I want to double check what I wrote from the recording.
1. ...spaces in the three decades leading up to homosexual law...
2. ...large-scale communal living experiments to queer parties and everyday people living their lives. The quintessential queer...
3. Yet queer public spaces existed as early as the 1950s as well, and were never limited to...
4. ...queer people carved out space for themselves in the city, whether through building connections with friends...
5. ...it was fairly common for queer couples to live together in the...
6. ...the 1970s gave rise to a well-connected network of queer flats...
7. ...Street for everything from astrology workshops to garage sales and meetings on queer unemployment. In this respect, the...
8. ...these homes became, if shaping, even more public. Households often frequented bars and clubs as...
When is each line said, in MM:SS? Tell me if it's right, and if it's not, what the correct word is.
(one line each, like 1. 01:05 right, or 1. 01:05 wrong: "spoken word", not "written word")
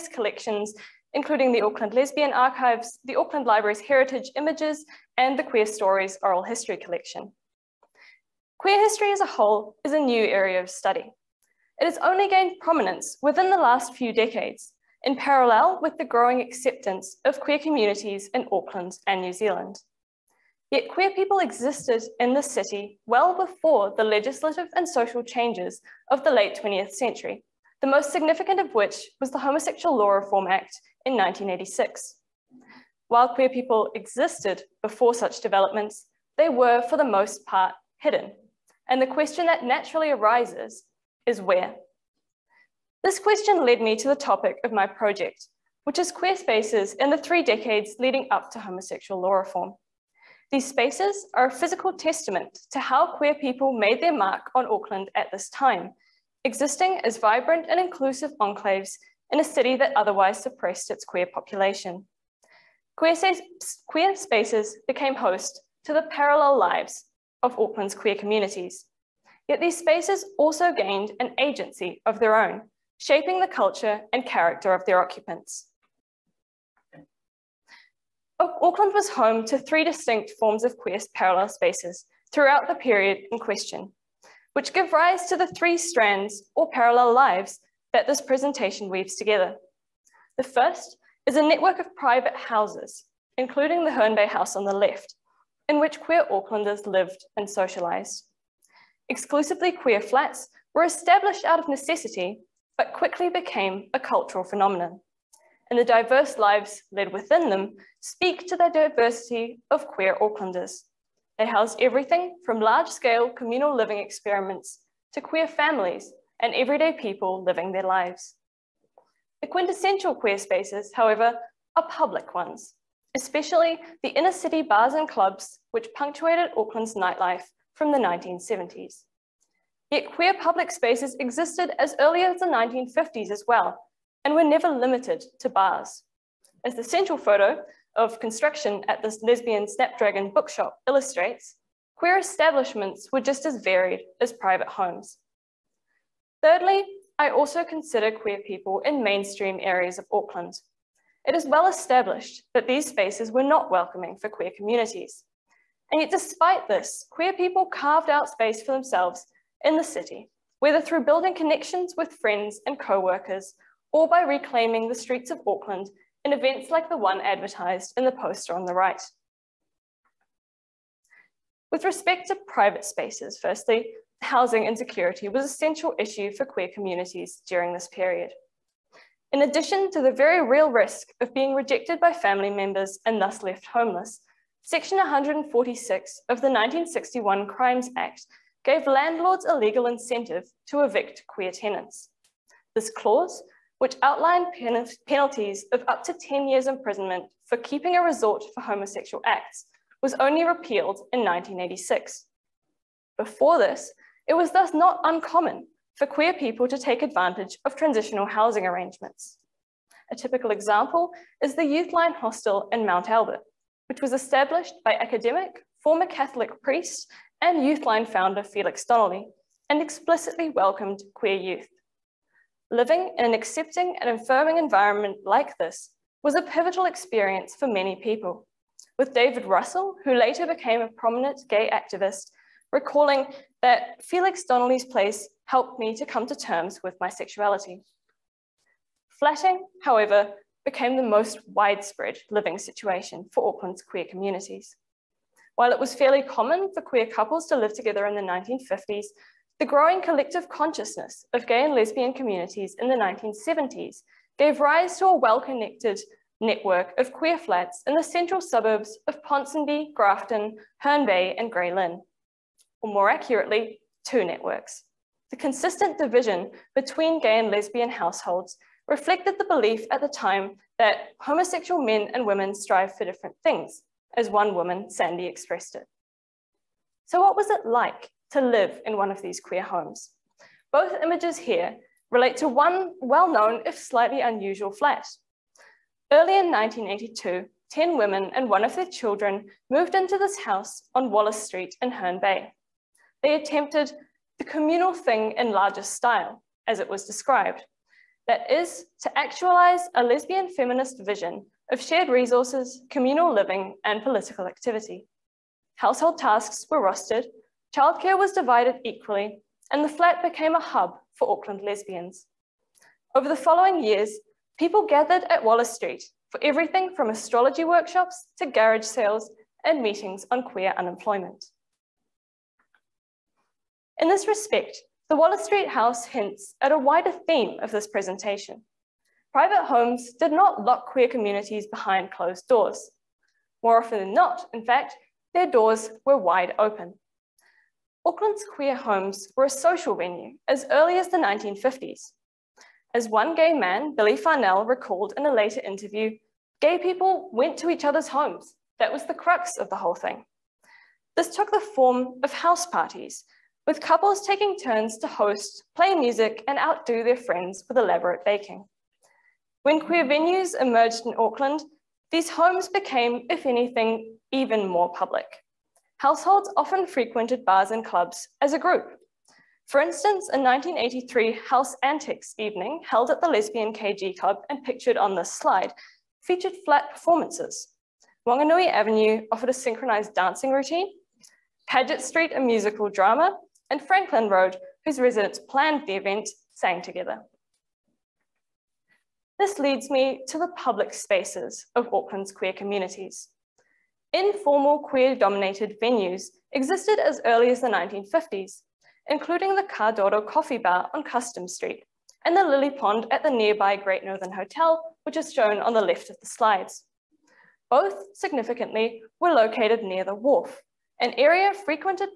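1. 00:46 right
2. 01:52 wrong: "families", not "parties"
3. 02:09 right
4. 02:37 right
5. 04:05 right
6. 04:12 right
7. 05:15 right
8. 06:02 wrong: "anything", not "shaping".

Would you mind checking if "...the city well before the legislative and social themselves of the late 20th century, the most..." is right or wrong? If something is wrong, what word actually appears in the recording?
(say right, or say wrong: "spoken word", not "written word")
wrong: "changes", not "themselves".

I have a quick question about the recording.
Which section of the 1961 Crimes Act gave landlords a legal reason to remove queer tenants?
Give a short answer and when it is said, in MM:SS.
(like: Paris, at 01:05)
Section 146, at 03:04.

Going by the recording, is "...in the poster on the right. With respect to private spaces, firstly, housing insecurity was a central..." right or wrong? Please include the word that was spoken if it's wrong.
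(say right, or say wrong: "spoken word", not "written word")
right.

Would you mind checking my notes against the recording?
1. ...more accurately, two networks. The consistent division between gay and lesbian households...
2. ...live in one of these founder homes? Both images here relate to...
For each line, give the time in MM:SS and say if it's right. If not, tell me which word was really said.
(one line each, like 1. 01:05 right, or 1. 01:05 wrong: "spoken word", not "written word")
1. 04:22 right
2. 04:38 wrong: "queer", not "founder".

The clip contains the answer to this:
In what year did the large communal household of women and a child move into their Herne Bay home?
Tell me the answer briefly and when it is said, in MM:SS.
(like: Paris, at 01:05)
1982, at 04:46.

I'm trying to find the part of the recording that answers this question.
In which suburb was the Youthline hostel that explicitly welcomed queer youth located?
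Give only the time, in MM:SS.
03:32.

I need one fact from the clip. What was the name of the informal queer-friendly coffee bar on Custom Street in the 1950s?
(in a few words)
Cardoro Coffee Bar.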